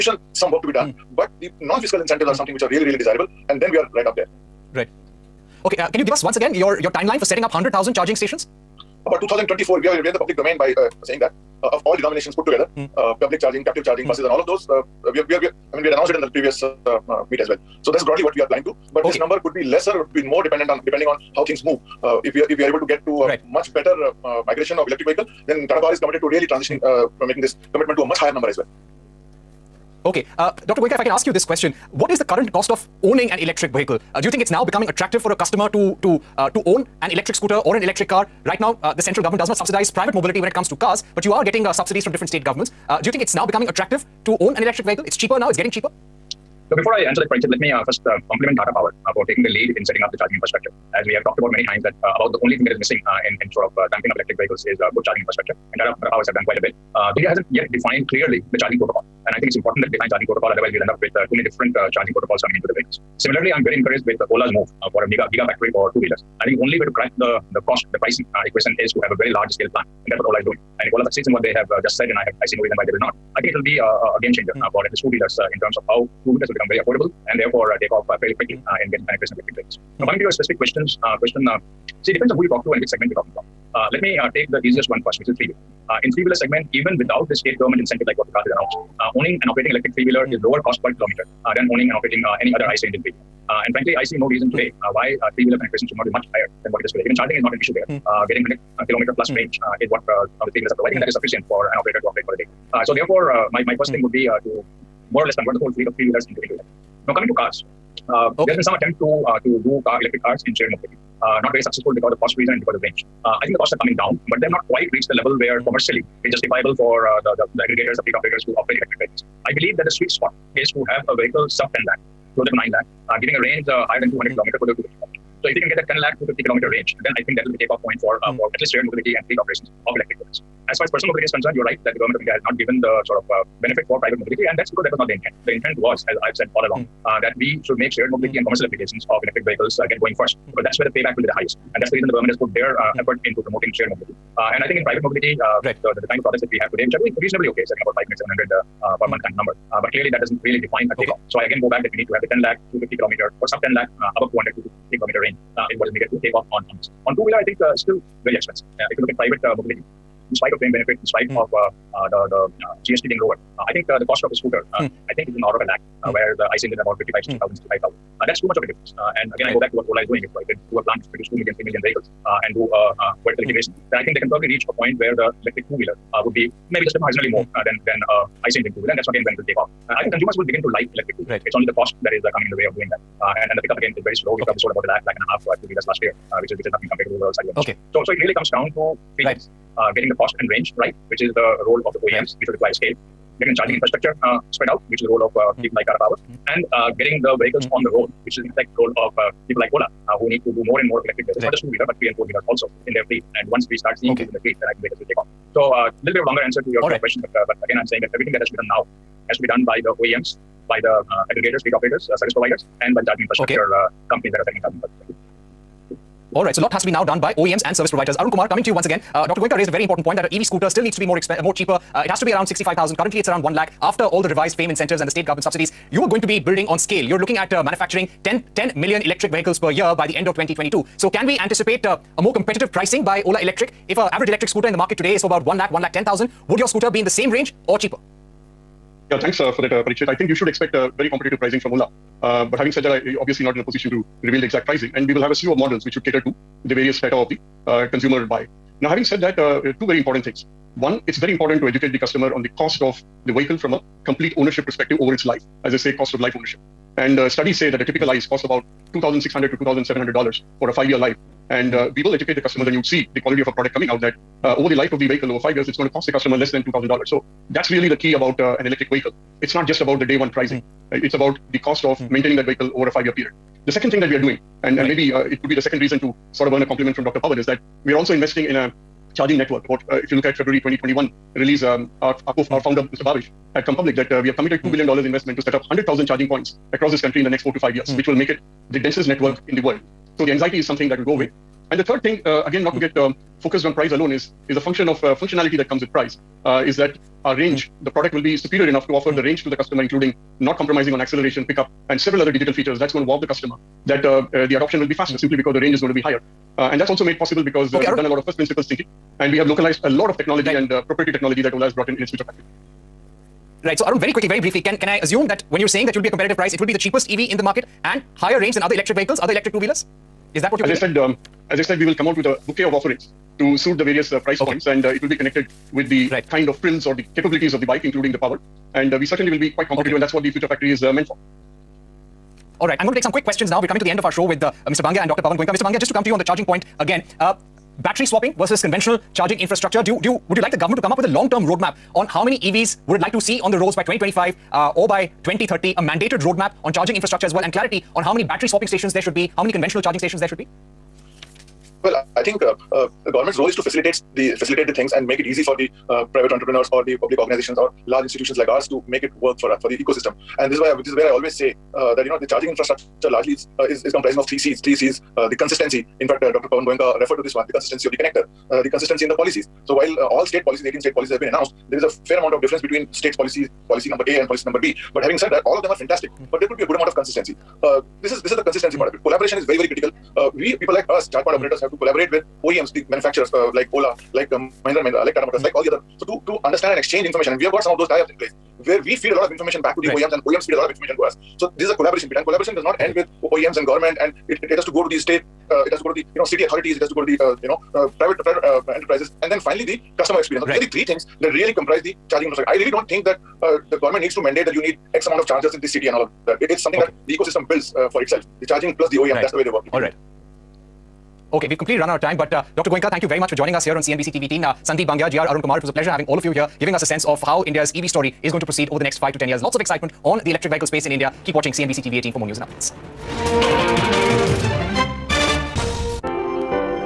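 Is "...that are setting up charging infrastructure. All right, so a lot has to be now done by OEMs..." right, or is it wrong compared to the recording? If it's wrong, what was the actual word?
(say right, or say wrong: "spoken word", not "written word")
right.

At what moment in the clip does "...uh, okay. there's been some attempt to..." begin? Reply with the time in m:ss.
1:48.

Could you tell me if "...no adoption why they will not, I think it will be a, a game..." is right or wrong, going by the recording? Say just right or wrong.
wrong.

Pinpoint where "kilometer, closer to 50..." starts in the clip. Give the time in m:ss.
2:04.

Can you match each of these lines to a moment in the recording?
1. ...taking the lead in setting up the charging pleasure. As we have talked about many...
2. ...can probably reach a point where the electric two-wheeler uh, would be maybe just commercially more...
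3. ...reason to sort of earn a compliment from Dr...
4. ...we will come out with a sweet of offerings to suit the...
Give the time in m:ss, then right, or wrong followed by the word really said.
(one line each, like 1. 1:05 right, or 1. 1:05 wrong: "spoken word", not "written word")
1. 0:49 wrong: "infrastructure", not "pleasure"
2. 2:54 wrong: "marginally", not "commercially"
3. 4:35 right
4. 5:21 wrong: "bouquet", not "sweet".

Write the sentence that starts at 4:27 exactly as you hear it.
So that's really the key about uh, an electric vehicle.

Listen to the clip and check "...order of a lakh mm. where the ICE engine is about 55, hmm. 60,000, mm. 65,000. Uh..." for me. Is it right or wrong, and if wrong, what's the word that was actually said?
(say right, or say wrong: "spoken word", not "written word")
right.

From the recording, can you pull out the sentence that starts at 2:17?
uh, that we should make shared mobility mm.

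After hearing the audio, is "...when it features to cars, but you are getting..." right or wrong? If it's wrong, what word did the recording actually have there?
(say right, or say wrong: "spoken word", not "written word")
wrong: "comes", not "features".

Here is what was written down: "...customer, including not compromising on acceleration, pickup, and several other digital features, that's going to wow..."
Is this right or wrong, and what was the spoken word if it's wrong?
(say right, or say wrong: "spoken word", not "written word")
right.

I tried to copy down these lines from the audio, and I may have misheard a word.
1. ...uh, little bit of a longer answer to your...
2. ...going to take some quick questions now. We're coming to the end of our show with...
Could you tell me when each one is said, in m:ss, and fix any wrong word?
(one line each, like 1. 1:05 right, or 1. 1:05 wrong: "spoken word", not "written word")
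1. 3:25 right
2. 5:32 right.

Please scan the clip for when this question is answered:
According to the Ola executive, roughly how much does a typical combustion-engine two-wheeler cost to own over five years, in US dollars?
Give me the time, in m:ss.
4:18.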